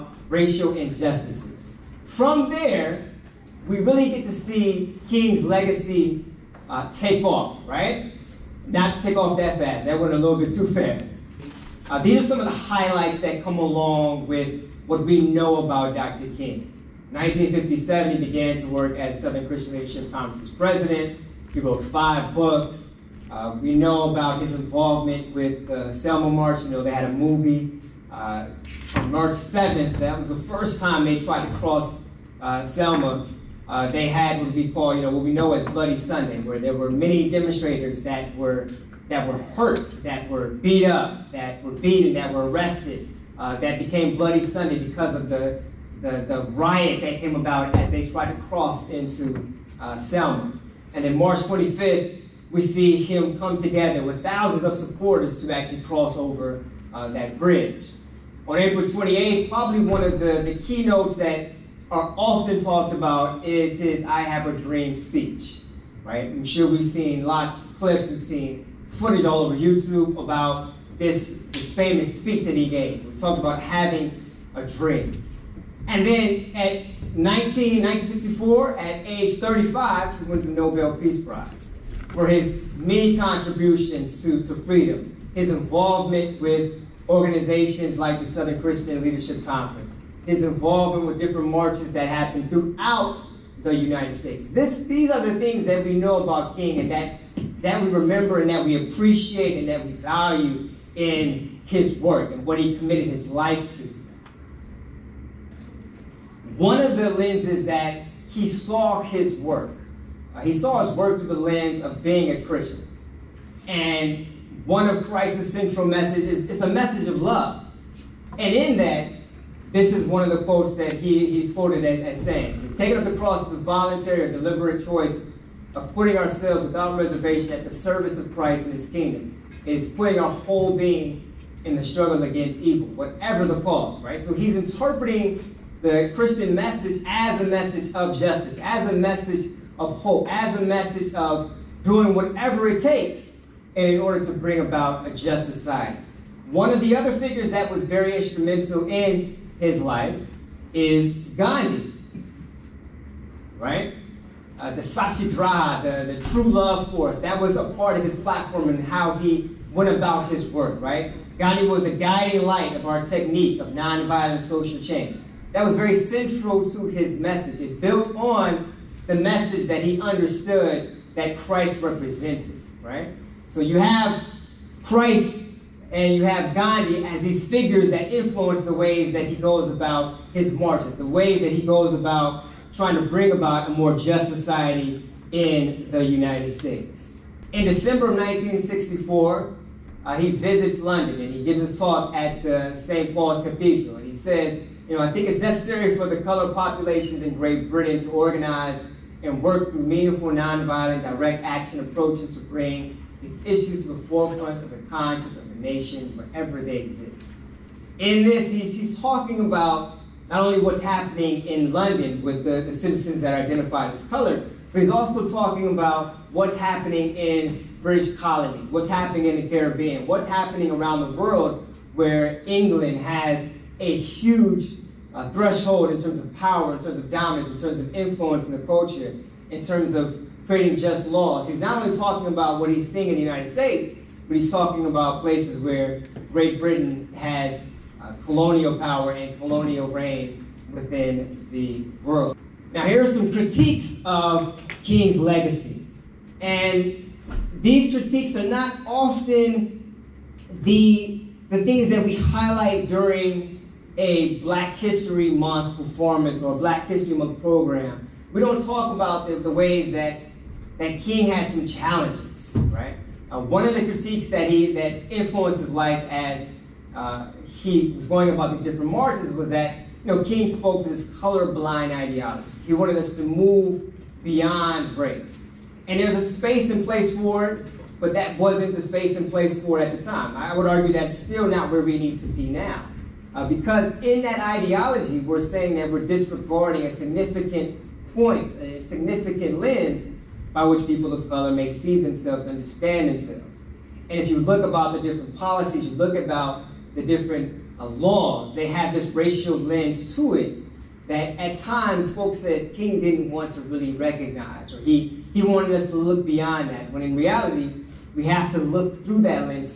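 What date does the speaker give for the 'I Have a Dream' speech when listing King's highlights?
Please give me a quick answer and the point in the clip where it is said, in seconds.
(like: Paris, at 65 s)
April 28th, at 58 s.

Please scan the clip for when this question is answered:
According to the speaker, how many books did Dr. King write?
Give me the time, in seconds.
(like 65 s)
21 s.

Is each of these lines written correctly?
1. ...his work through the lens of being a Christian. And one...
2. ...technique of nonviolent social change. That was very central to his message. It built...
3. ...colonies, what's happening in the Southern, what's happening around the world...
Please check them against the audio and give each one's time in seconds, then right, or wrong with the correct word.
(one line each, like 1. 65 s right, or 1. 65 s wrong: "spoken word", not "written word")
1. 110 s right
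2. 163 s right
3. 218 s wrong: "Caribbean", not "Southern".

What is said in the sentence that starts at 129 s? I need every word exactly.
It is putting our whole being in the struggle against evil, whatever the cause, right?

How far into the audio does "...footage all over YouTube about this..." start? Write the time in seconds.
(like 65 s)
68 s.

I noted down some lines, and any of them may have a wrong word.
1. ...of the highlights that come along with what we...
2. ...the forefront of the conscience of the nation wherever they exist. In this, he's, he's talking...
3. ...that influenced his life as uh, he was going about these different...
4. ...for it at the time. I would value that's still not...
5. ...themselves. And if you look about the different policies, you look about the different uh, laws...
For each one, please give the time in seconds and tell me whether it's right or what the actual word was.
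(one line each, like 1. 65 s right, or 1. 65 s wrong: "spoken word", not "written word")
1. 12 s right
2. 203 s right
3. 264 s right
4. 279 s wrong: "argue", not "value"
5. 293 s right.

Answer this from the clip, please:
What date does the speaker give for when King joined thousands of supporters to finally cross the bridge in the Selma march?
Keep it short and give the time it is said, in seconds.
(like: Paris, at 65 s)
March 25th, at 51 s.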